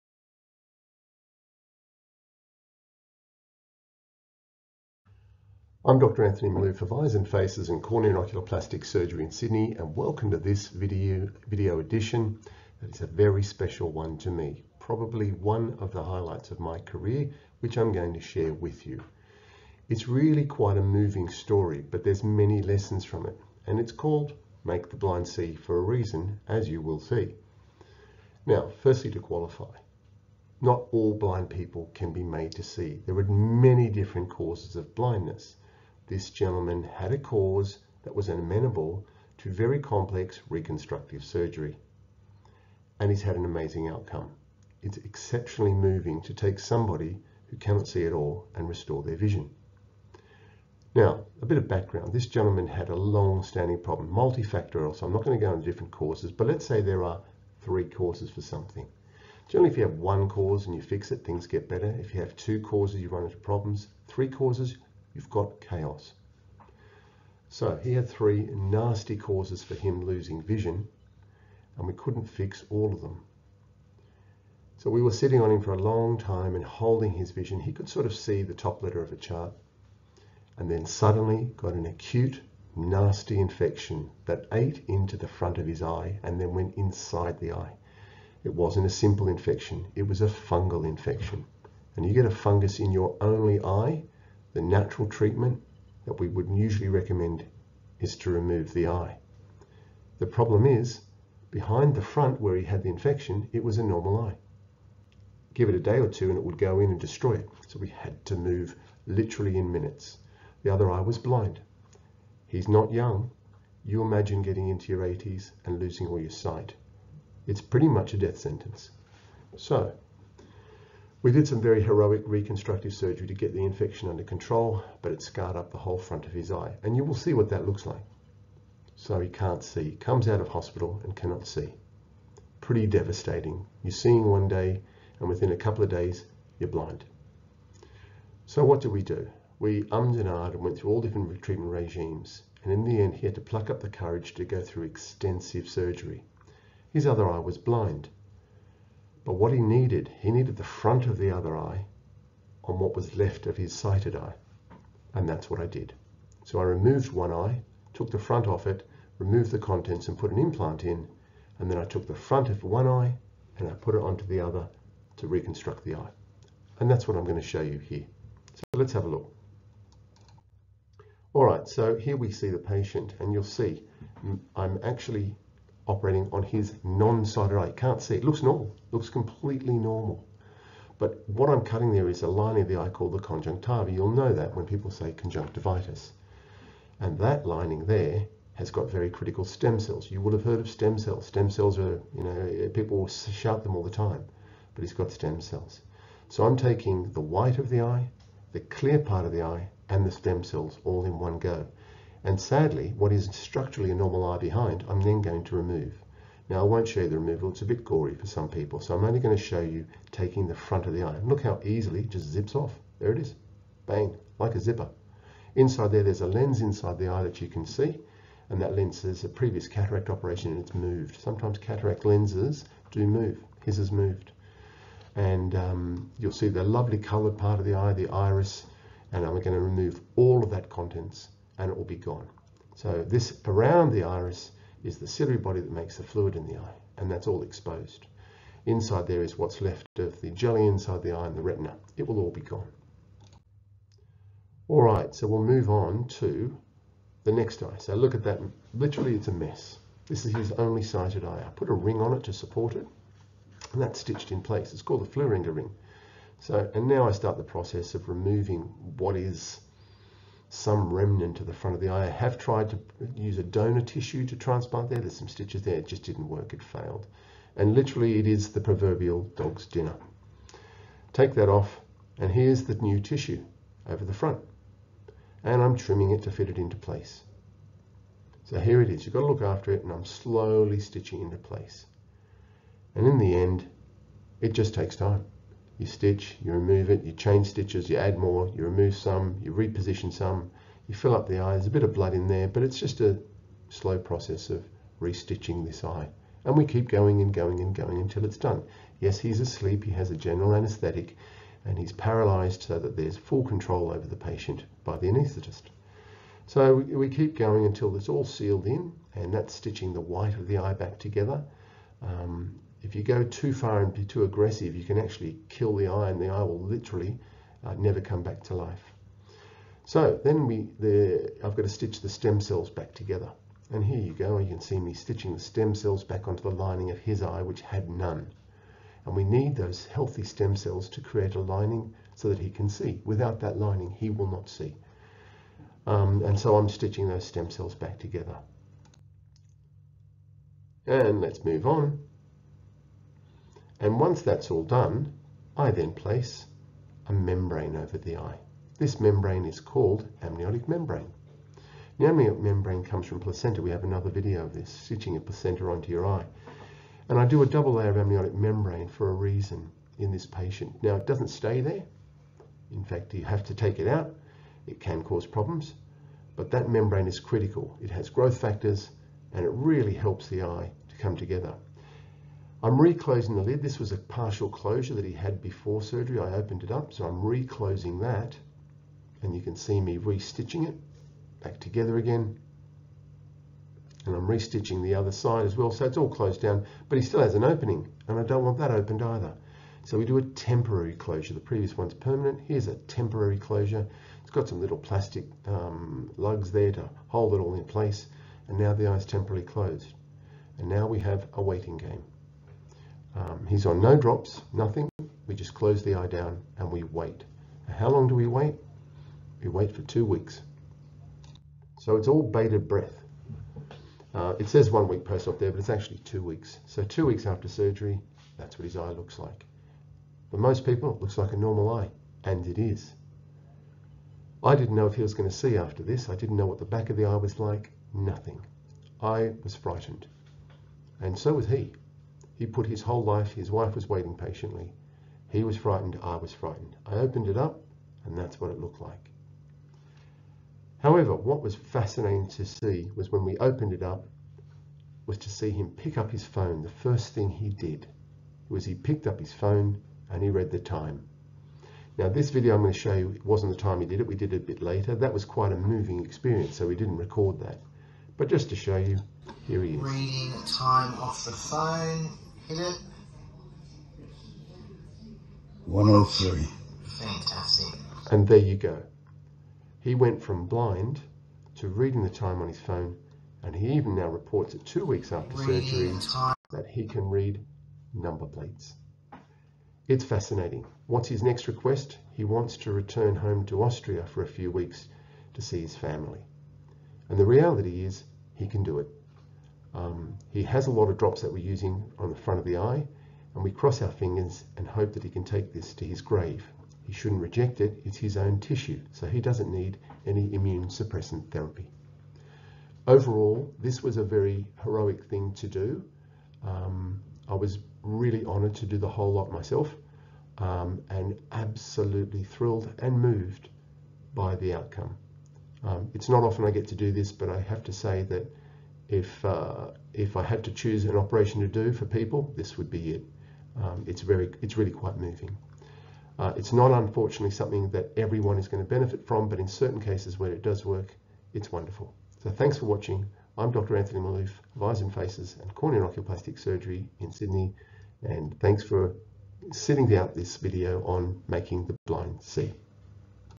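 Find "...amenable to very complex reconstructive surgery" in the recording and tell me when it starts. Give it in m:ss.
0:38.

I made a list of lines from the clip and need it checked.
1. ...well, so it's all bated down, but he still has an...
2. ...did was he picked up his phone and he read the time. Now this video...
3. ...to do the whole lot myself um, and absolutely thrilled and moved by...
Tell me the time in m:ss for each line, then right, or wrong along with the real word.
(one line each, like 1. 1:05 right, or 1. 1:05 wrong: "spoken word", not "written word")
1. 6:25 wrong: "closed", not "bated"
2. 7:27 right
3. 8:28 right.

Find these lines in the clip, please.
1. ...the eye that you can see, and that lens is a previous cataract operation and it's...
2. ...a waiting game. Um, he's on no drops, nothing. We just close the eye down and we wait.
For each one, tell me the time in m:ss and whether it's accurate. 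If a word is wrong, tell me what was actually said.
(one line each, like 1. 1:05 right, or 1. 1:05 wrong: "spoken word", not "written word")
1. 3:36 right
2. 6:41 right.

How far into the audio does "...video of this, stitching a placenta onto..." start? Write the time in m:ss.
5:54.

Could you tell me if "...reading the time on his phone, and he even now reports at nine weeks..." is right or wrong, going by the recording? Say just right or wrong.
wrong.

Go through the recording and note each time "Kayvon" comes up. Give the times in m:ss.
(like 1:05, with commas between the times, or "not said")
not said.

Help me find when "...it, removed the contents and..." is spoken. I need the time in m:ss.
2:38.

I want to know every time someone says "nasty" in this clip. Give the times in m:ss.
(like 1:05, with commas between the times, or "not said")
1:08, 1:22.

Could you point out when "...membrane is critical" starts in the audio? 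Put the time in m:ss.
6:06.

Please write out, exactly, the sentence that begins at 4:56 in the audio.
And we keep going and going and going until it's done.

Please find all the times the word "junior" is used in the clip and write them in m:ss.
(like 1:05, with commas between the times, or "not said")
not said.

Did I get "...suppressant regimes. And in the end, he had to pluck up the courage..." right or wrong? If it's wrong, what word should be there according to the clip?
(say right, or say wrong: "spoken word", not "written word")
wrong: "treatment", not "suppressant".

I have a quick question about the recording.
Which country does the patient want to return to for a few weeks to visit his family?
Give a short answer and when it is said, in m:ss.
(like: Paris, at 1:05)
Austria, at 8:03.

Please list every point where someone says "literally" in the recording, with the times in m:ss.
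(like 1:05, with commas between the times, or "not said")
1:49, 4:08, 4:27, 5:16.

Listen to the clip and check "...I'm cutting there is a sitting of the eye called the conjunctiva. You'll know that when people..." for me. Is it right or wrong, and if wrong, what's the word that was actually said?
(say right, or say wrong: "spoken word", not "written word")
wrong: "lining", not "sitting".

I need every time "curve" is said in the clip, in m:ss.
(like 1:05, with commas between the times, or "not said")
not said.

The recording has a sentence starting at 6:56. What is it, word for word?
So two weeks after surgery, that's what his eye looks like.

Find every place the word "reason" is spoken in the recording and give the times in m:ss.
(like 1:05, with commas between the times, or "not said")
0:25, 5:59.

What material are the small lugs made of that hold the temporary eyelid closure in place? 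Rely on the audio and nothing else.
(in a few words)
Plastic.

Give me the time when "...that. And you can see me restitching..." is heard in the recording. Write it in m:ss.
6:18.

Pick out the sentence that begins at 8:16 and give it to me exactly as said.
He shouldn't reject it, it's his own tissue, so he doesn't need any immune suppressant therapy.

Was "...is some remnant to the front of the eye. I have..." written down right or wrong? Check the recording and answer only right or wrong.
right.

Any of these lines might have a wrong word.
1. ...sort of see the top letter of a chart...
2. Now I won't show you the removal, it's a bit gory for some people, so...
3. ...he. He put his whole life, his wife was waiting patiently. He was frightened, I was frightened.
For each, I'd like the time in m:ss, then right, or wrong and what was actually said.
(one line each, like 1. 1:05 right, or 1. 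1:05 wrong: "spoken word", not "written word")
1. 1:17 right
2. 3:26 right
3. 7:11 right.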